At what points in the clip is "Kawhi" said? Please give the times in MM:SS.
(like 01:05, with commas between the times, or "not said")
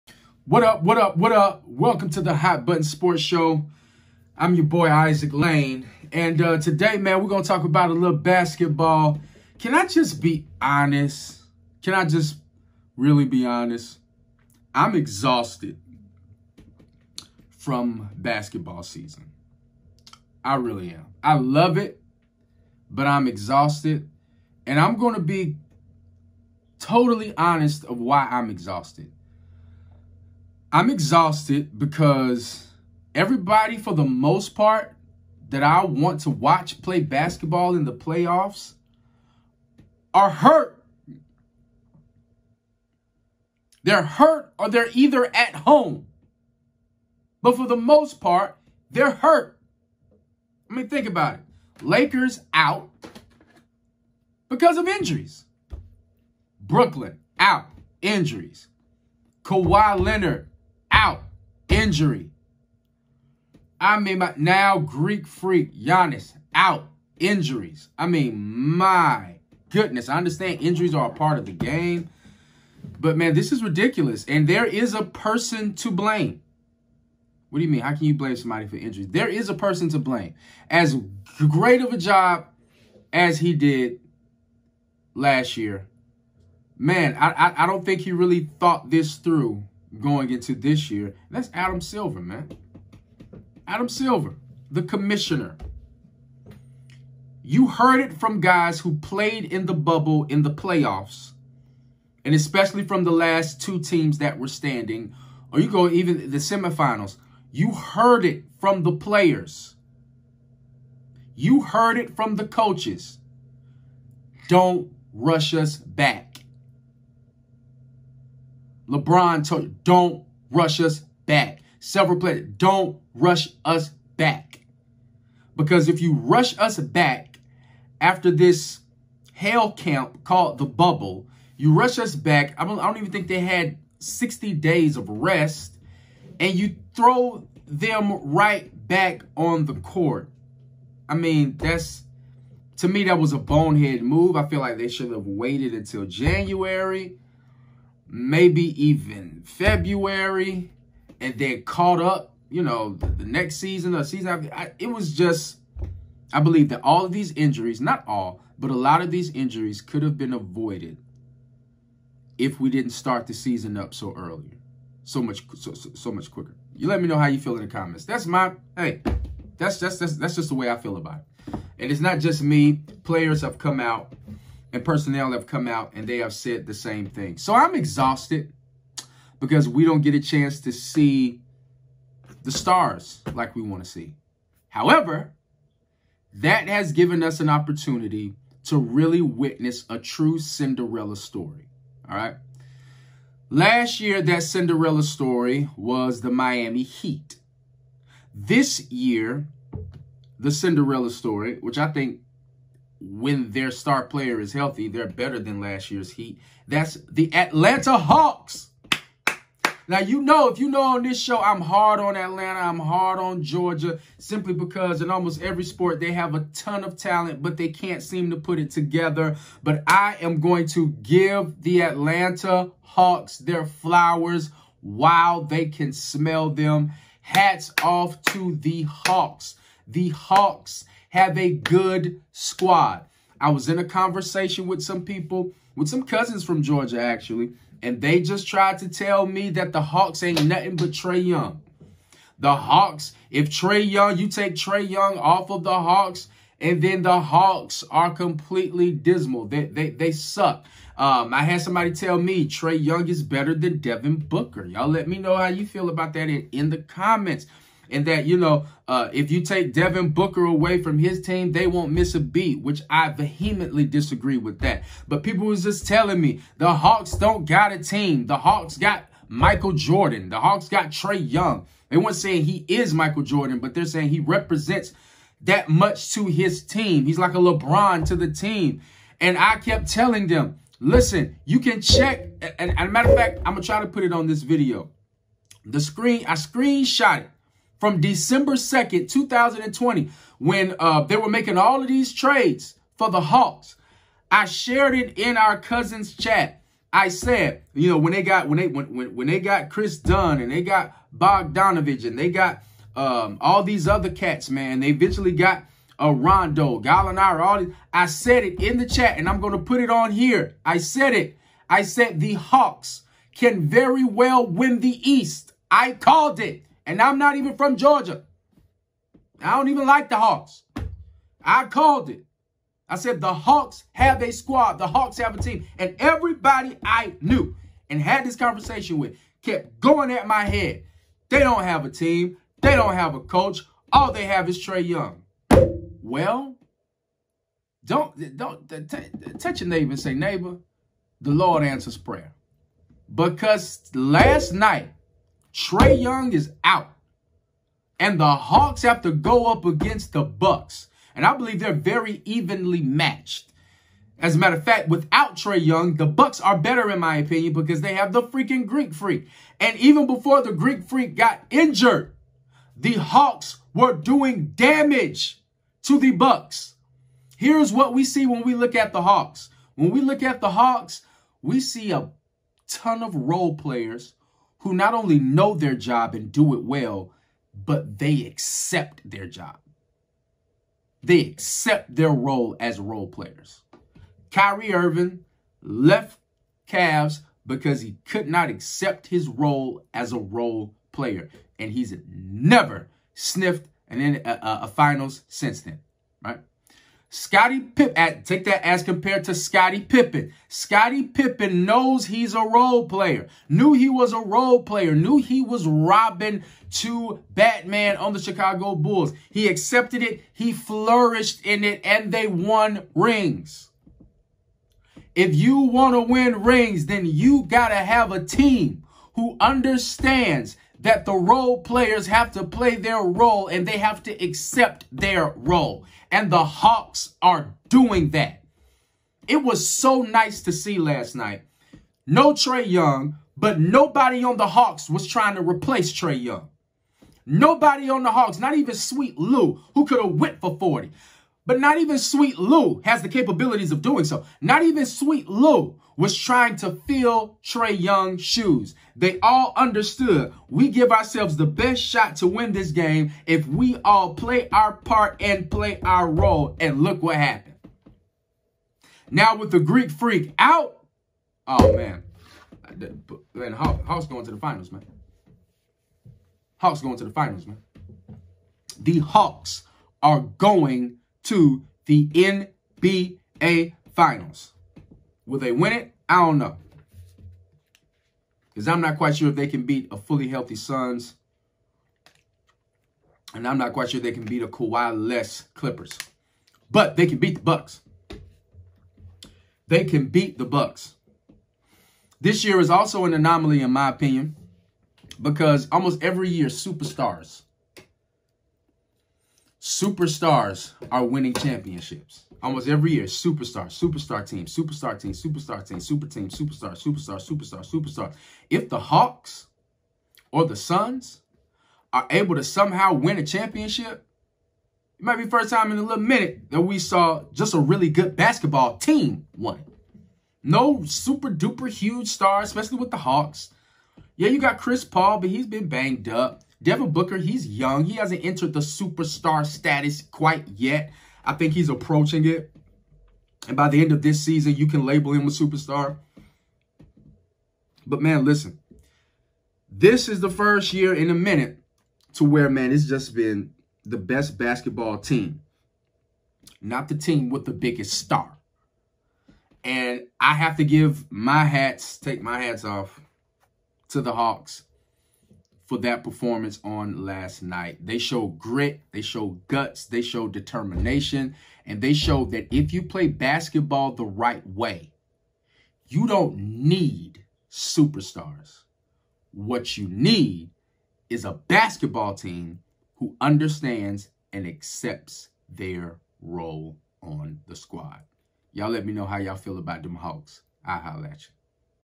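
00:59, 08:04.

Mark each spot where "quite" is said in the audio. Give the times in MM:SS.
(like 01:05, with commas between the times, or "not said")
07:58, 08:03, 08:50.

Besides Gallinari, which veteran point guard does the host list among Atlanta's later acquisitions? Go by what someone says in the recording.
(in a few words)
Rondo.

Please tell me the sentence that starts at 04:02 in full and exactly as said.
The Hawks, if Trae Young, you take Trae Young off of the Hawks, and then the Hawks are completely dismal.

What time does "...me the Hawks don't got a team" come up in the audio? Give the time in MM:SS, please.
04:26.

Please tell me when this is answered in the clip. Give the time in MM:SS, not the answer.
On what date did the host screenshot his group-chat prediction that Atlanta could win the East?
04:47.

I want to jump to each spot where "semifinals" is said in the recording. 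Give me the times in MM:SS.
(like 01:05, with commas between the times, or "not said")
01:46.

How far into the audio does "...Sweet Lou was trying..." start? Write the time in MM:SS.
07:24.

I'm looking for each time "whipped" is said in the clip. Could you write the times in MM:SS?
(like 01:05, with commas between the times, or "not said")
07:20.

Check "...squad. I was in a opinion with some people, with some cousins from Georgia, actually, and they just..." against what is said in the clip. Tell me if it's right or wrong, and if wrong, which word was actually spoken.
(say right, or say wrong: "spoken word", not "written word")
wrong: "conversation", not "opinion".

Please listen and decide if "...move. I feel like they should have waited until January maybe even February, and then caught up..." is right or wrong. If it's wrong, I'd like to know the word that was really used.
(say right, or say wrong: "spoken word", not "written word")
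right.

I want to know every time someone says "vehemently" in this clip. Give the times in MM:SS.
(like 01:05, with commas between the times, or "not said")
04:23.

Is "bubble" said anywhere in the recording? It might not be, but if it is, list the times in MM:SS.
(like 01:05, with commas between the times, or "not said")
01:39, 02:10.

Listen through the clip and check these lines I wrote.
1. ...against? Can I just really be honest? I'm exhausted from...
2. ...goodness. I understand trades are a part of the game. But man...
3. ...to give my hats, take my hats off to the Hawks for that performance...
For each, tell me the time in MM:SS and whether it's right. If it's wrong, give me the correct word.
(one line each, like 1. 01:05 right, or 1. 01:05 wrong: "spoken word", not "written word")
1. 00:10 wrong: "honest", not "against"
2. 01:09 wrong: "injuries", not "trades"
3. 09:10 right.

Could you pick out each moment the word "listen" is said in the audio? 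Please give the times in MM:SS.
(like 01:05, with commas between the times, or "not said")
04:40, 08:58.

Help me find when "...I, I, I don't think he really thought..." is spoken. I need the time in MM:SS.
01:27.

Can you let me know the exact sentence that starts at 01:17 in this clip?
How can you blame somebody for injuries?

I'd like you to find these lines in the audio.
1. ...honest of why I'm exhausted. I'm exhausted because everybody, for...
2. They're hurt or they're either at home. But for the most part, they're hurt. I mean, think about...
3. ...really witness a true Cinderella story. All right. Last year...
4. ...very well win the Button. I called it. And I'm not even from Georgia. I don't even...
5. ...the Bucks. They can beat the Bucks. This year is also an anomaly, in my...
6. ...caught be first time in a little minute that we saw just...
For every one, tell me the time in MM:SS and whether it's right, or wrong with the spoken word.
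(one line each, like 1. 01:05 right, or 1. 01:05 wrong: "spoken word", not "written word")
1. 00:27 right
2. 00:43 right
3. 03:08 right
4. 05:13 wrong: "East", not "Button"
5. 08:07 right
6. 08:35 wrong: "might", not "caught".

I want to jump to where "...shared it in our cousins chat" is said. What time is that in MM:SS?
04:54.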